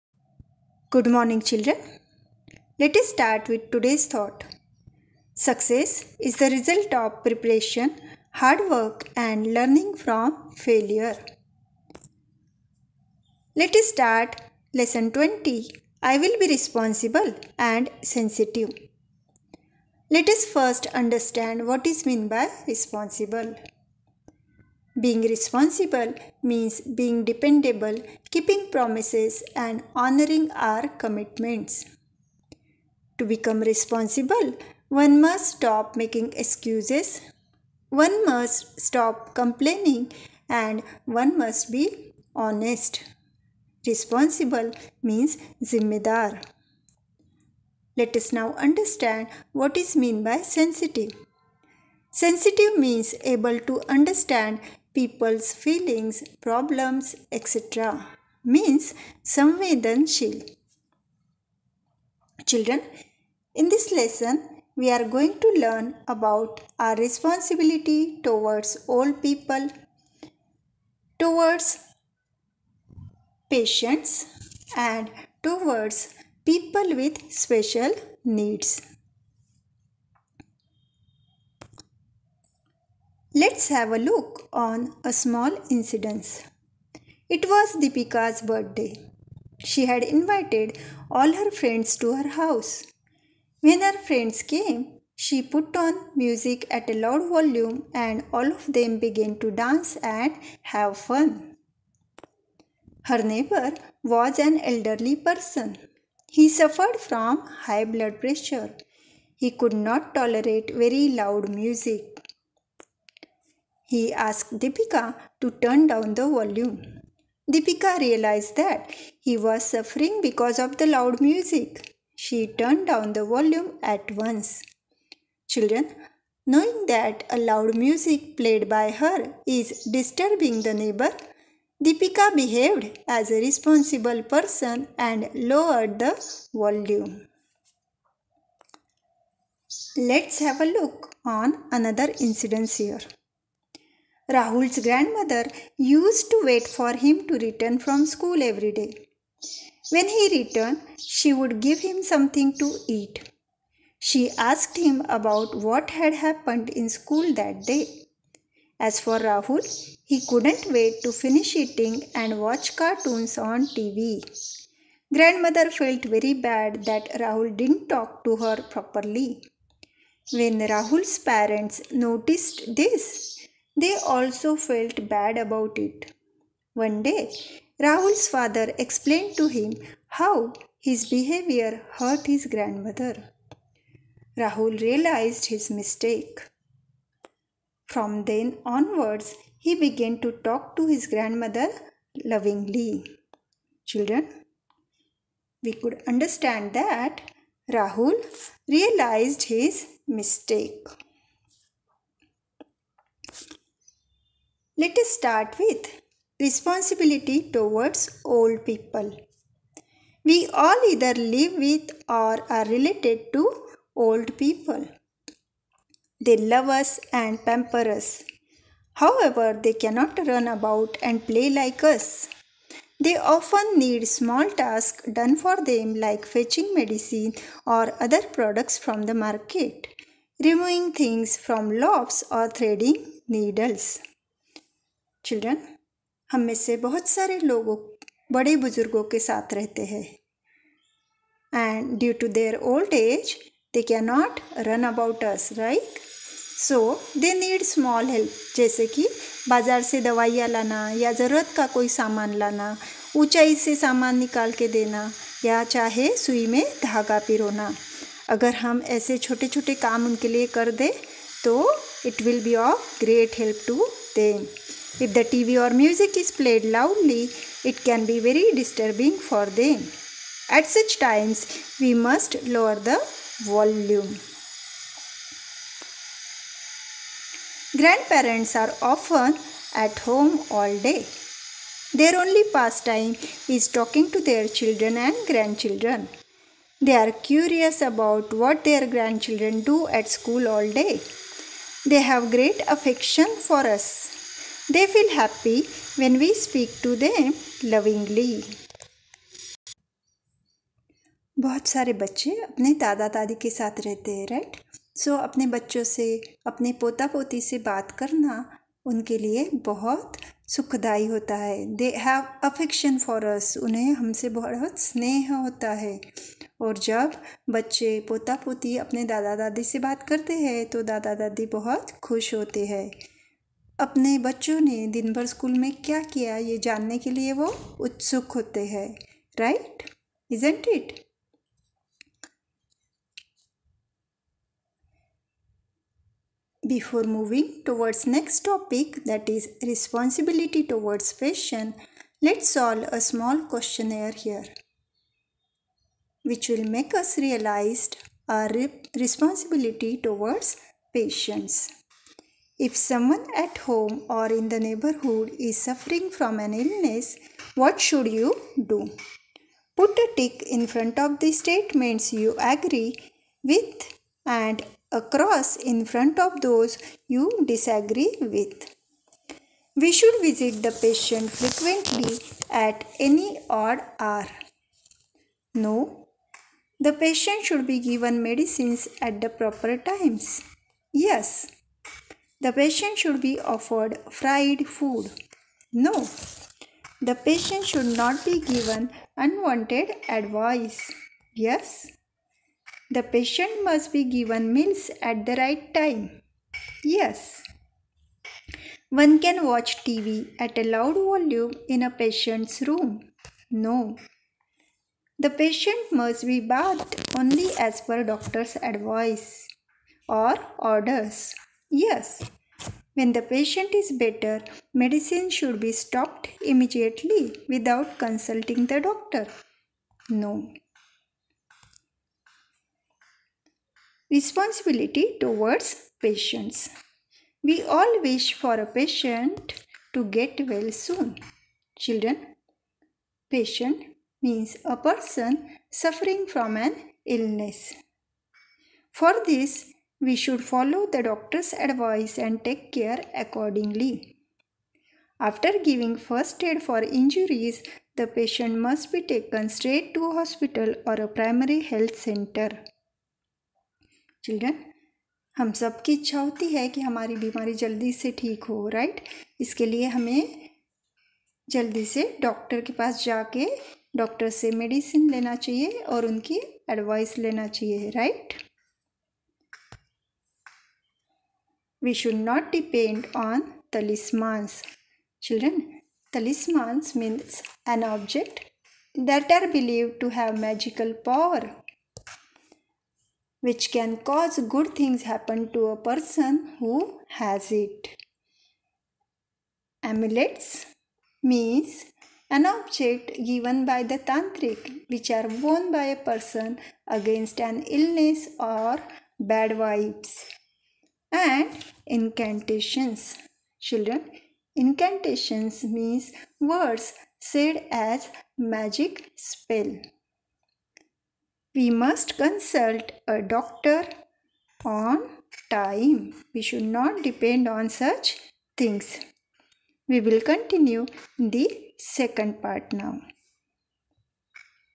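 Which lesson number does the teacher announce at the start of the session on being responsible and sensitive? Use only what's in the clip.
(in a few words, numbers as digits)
20.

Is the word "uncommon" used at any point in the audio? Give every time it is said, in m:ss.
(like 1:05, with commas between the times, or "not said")
not said.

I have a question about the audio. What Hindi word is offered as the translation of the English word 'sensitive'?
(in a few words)
Samvedanshil.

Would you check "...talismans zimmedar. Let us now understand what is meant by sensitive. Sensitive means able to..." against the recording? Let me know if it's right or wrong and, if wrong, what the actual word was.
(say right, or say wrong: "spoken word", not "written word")
wrong: "means", not "talismans".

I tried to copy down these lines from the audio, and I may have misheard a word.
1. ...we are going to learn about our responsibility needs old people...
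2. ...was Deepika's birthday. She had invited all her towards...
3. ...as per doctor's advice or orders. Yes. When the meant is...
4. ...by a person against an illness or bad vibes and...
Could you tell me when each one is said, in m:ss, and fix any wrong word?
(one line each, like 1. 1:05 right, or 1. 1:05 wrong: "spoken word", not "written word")
1. 1:04 wrong: "towards", not "needs"
2. 1:27 wrong: "friends", not "towards"
3. 6:47 wrong: "patient", not "meant"
4. 8:15 right.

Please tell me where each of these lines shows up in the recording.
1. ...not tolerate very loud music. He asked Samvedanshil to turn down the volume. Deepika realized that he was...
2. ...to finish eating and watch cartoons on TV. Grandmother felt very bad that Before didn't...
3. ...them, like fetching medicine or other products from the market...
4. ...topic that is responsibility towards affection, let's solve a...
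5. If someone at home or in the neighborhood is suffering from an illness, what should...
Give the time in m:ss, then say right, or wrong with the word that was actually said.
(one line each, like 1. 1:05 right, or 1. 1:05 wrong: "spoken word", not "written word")
1. 1:49 wrong: "Deepika", not "Samvedanshil"
2. 2:41 wrong: "Rahul", not "Before"
3. 3:45 right
4. 5:38 wrong: "fashion", not "affection"
5. 5:52 right.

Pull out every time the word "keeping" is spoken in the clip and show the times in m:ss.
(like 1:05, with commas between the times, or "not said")
0:28.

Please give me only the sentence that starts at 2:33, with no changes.
She asked him about what had happened in school that day.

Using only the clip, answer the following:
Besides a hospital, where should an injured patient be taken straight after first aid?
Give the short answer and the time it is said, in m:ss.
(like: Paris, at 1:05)
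Primary health center, at 7:31.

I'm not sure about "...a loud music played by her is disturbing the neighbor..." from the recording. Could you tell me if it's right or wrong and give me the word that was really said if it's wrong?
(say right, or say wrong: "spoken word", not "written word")
right.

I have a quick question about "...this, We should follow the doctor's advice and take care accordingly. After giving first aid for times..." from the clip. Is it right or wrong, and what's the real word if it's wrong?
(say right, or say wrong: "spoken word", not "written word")
wrong: "injuries", not "times".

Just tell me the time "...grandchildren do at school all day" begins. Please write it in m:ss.
4:48.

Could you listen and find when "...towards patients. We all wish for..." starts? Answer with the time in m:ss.
7:05.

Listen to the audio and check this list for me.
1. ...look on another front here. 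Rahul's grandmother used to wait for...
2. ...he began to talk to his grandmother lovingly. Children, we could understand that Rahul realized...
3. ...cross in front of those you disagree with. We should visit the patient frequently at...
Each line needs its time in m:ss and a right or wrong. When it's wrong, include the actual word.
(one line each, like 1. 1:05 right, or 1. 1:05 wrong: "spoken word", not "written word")
1. 2:20 wrong: "incident", not "front"
2. 3:09 right
3. 6:05 right.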